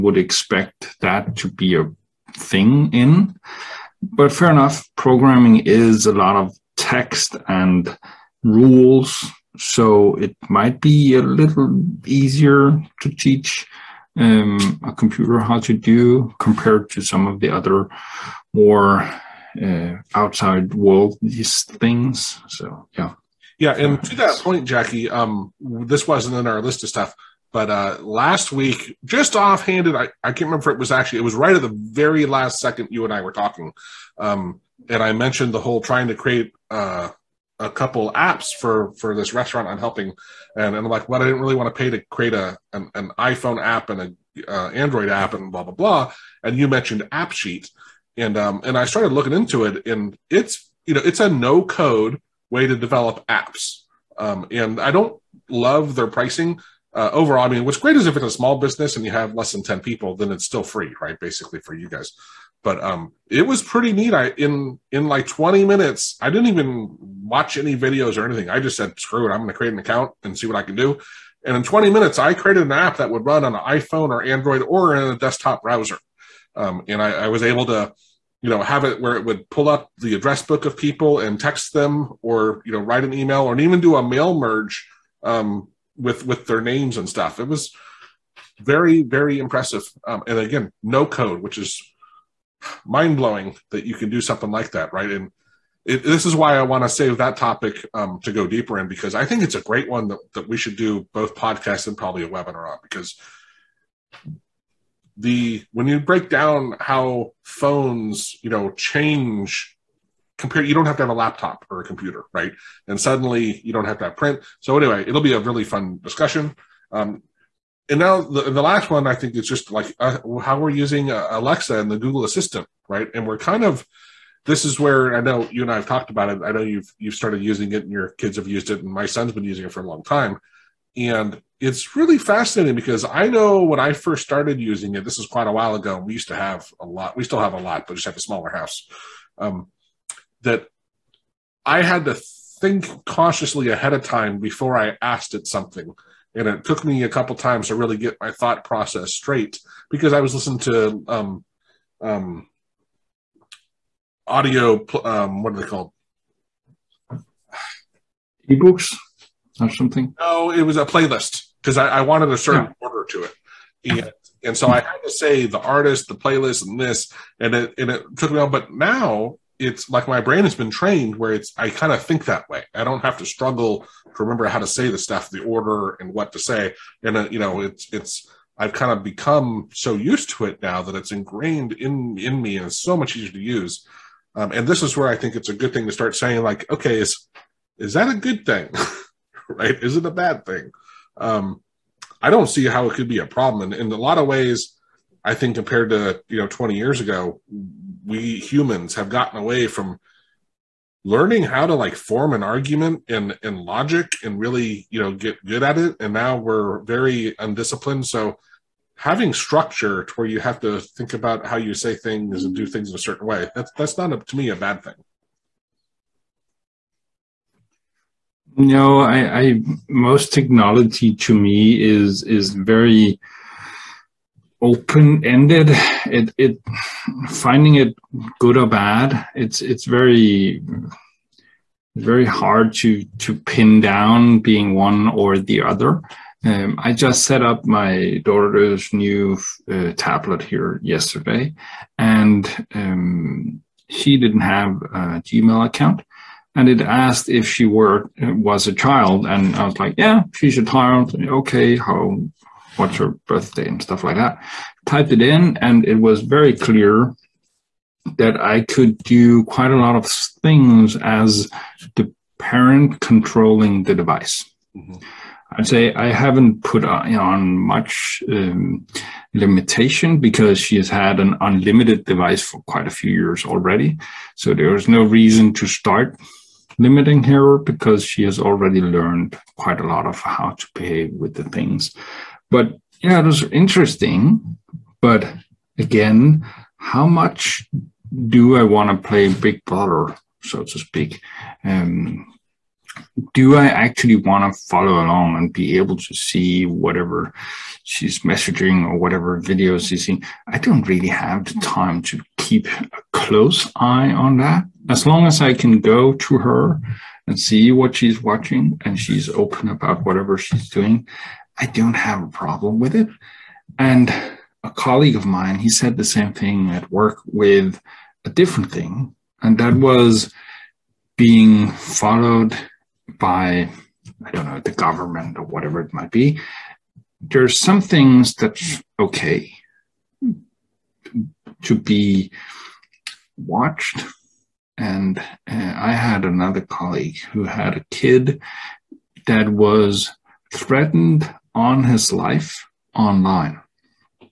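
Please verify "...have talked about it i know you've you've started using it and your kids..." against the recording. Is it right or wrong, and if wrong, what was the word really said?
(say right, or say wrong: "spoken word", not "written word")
right.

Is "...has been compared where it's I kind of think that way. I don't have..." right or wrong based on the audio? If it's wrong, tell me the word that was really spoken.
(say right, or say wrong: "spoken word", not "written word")
wrong: "trained", not "compared".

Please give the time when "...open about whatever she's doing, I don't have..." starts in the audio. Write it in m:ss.
5:09.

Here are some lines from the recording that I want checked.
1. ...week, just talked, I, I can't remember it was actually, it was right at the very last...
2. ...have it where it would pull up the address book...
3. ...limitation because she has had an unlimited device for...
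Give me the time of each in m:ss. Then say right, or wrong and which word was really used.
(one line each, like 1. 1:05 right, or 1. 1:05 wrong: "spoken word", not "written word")
1. 0:28 wrong: "offhanded", not "talked"
2. 1:18 right
3. 4:29 right.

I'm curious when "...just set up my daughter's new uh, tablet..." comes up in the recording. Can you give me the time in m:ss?
3:56.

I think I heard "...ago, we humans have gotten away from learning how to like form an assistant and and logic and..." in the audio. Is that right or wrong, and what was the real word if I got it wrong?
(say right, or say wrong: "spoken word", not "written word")
wrong: "argument", not "assistant".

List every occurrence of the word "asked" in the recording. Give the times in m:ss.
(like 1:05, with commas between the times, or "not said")
2:25, 4:06.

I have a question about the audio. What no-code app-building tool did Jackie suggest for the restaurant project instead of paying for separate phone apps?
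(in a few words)
AppSheet.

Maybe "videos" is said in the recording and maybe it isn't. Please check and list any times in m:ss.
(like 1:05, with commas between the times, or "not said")
1:07, 4:59.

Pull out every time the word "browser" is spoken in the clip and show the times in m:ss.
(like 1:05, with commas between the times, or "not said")
1:15.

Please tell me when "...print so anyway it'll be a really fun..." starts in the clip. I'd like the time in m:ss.
1:54.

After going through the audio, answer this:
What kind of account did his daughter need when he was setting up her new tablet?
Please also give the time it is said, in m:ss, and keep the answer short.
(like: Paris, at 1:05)
Gmail, at 4:05.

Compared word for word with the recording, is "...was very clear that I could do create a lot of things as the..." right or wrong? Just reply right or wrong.
wrong.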